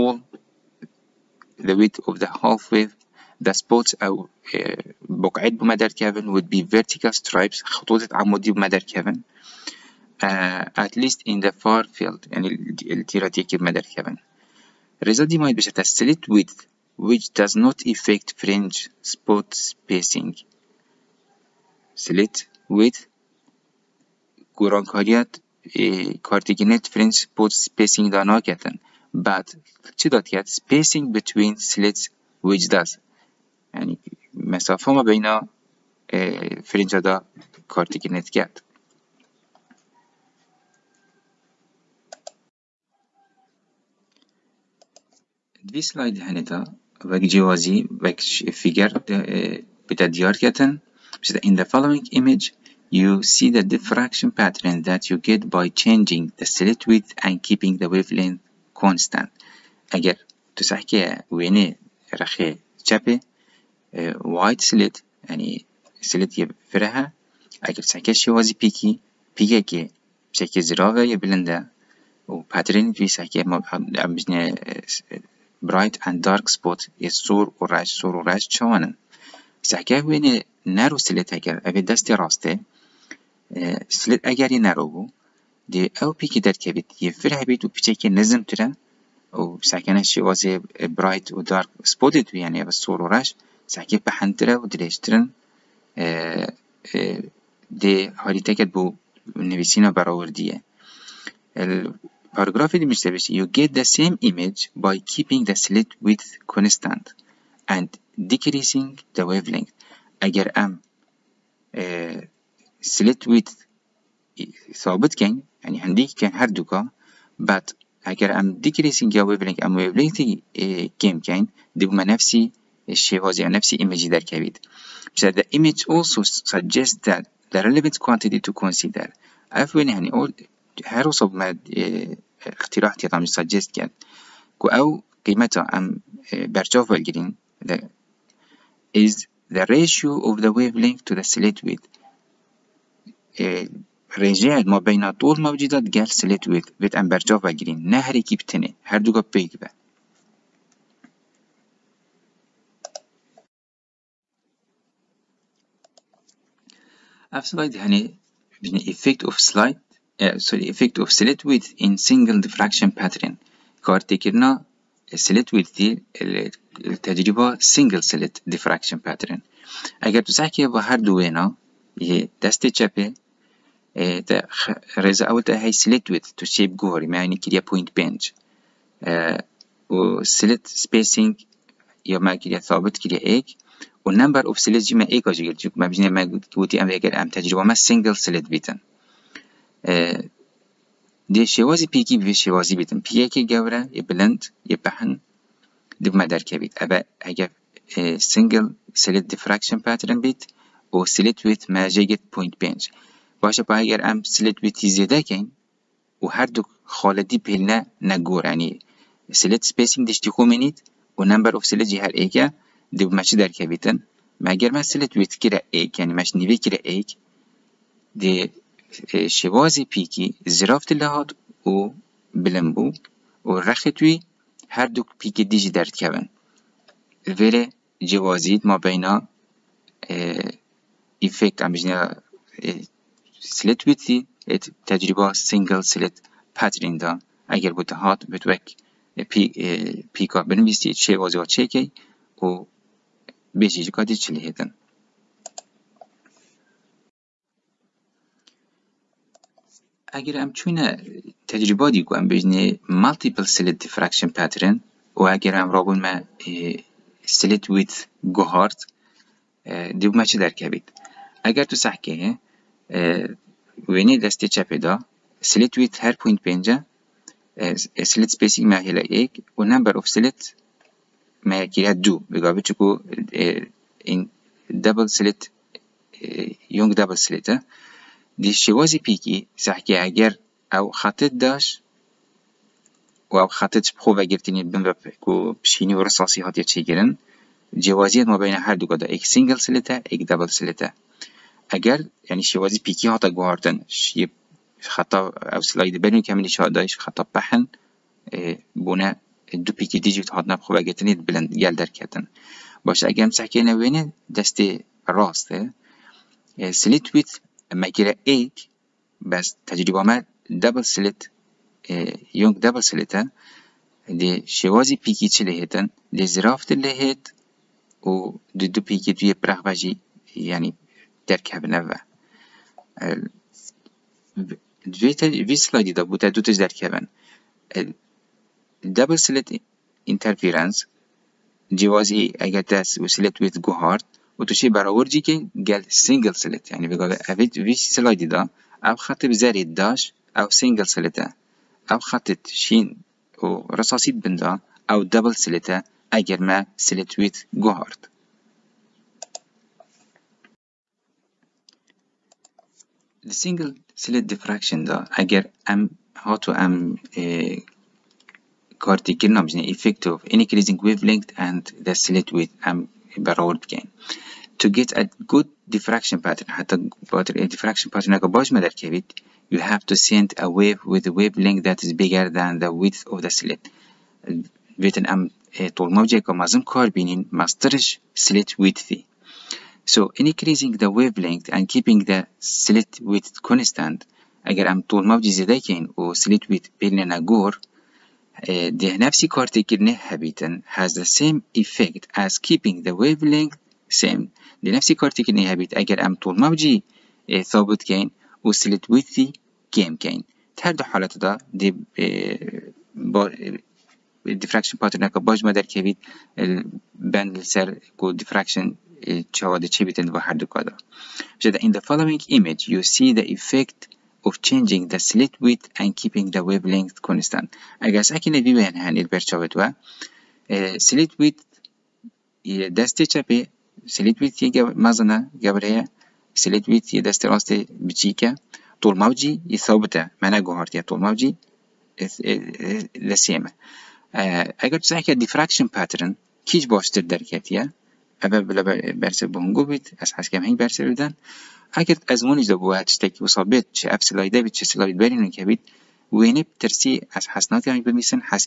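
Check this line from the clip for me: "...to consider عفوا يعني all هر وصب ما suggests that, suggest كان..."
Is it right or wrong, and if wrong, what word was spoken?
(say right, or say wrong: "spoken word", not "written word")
right.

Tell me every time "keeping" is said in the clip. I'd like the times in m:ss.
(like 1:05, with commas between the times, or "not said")
0:57, 1:45, 6:21, 6:32, 6:55.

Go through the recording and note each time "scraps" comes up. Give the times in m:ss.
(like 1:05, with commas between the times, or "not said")
not said.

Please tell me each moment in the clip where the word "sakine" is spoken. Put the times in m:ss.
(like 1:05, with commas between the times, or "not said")
6:58.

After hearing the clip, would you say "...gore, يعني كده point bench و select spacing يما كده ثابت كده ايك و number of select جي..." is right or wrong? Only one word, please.
right.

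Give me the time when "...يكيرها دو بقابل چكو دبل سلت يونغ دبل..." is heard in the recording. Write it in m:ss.
4:31.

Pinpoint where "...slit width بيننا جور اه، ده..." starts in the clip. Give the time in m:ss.
6:26.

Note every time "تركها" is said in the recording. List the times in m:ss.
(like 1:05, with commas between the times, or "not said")
5:21, 5:26.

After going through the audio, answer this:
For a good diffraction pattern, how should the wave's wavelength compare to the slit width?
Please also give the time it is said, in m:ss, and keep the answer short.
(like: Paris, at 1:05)
bigger, at 6:12.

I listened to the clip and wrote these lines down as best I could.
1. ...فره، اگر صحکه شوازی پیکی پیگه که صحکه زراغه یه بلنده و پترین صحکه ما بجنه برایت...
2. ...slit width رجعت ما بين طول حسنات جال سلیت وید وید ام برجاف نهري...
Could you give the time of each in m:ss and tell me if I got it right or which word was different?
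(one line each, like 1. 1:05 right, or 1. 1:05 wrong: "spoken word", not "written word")
1. 1:06 right
2. 2:21 wrong: "موجودات", not "حسنات".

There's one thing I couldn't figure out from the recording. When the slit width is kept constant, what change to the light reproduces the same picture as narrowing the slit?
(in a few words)
decreasing the wavelength.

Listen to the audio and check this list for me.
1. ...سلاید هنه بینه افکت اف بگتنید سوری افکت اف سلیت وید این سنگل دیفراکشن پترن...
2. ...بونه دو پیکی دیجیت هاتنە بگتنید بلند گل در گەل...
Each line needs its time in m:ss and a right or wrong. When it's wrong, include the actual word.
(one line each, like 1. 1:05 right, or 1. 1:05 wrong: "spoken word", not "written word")
1. 2:37 wrong: "سلاید", not "بگتنید"
2. 4:58 right.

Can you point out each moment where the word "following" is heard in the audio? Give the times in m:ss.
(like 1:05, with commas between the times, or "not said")
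0:51, 6:51.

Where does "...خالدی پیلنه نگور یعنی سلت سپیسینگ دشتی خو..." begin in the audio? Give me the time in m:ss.
3:26.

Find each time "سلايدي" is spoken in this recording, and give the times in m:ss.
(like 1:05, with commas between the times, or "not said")
5:25, 5:37.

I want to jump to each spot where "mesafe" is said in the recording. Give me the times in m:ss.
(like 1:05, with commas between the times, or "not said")
0:34.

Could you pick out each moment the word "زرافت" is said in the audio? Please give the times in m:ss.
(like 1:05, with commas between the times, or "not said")
3:40, 5:16.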